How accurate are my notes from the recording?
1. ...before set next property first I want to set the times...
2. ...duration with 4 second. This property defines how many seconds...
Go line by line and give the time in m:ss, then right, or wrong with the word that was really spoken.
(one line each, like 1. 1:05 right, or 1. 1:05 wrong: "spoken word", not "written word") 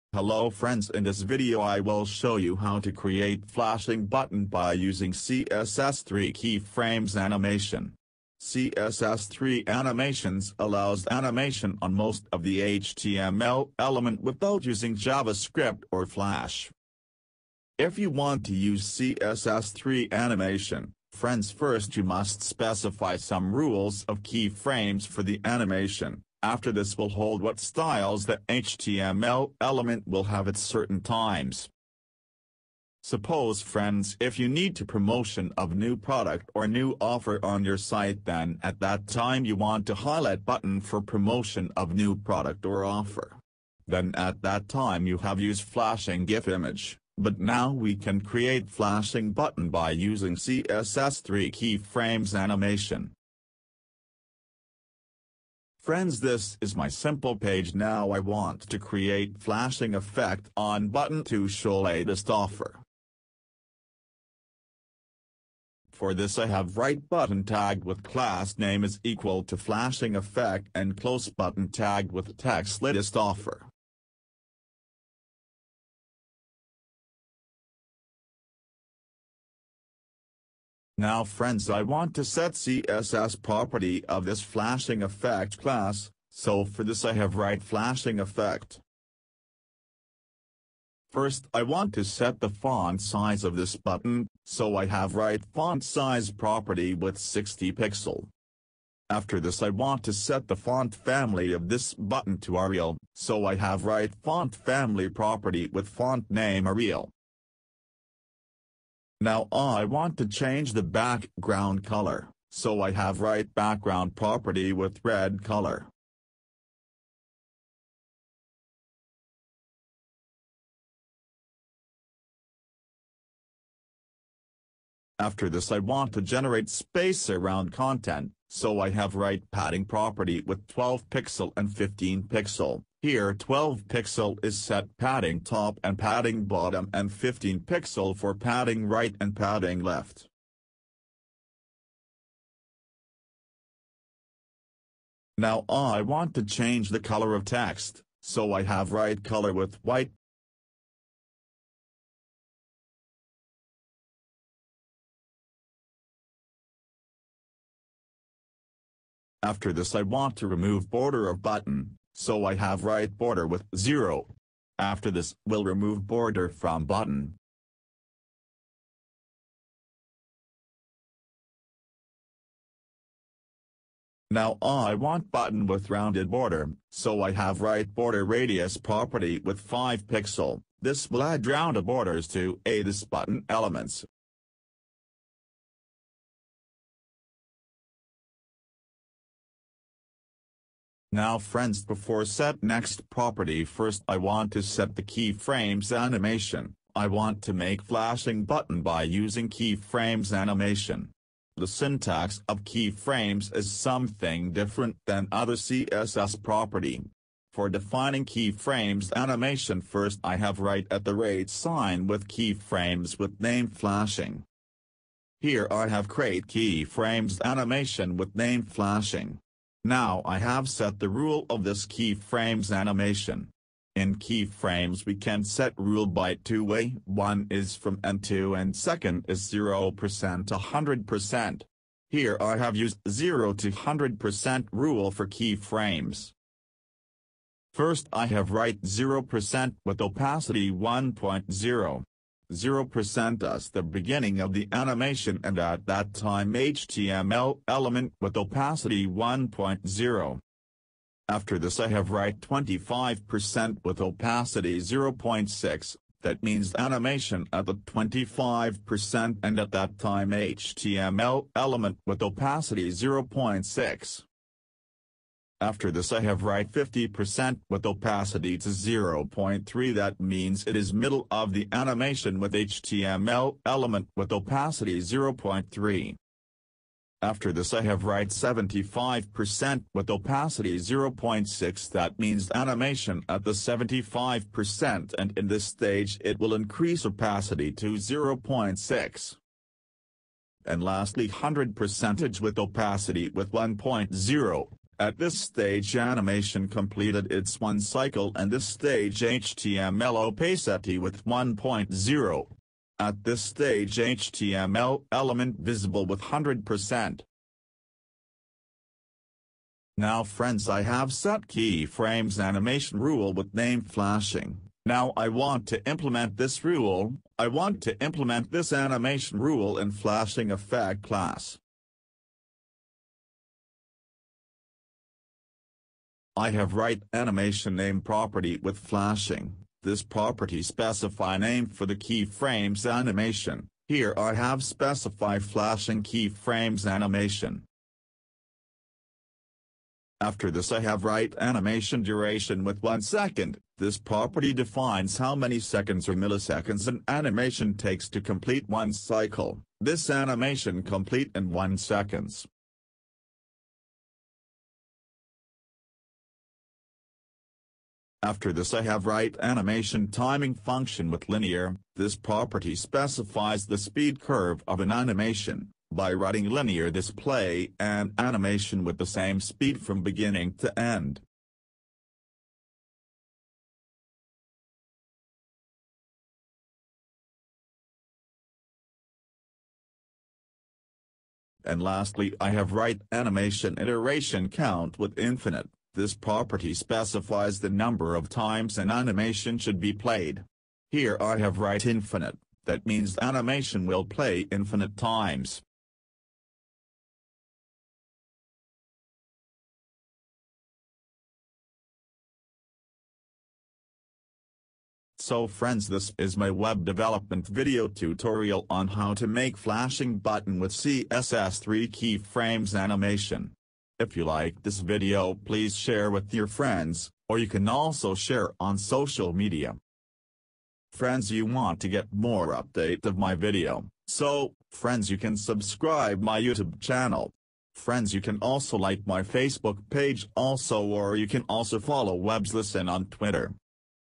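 1. 3:11 wrong: "keyframes", not "times"
2. 5:42 wrong: "1", not "4".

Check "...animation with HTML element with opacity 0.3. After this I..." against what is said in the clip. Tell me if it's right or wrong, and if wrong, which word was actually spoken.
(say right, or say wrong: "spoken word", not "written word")
right.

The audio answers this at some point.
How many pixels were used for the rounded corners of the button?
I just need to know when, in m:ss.
2:59.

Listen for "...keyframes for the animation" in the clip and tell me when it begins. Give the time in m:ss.
0:24.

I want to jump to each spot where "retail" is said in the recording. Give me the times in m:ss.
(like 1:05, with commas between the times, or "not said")
not said.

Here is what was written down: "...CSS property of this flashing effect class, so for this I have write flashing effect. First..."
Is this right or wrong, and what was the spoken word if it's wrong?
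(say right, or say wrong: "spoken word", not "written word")
right.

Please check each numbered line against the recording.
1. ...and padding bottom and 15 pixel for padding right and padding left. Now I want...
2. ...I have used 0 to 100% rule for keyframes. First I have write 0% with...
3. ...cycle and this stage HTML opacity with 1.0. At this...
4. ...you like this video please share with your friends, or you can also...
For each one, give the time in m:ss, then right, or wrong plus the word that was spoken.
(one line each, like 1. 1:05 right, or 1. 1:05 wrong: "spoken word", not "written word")
1. 2:15 right
2. 3:52 right
3. 4:57 right
4. 6:54 right.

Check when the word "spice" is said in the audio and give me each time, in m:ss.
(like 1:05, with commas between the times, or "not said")
not said.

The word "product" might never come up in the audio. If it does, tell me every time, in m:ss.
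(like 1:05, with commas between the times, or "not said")
0:35, 0:42.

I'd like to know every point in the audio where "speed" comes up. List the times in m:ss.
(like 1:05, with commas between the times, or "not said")
6:03, 6:09.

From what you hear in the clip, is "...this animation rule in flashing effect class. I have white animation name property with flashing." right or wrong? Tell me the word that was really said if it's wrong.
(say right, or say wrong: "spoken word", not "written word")
wrong: "write", not "white".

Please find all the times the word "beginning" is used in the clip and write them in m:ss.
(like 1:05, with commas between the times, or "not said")
4:03, 6:10.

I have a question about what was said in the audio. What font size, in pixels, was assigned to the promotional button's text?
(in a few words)
60 pixel.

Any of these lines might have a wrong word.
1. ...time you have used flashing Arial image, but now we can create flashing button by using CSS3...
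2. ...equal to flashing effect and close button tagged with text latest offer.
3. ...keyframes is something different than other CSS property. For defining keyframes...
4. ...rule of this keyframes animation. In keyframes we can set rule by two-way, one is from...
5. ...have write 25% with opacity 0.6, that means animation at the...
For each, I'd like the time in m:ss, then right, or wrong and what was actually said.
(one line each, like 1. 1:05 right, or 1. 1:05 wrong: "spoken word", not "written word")
1. 0:44 wrong: "GIF", not "Arial"
2. 1:09 right
3. 3:22 right
4. 3:41 right
5. 4:11 right.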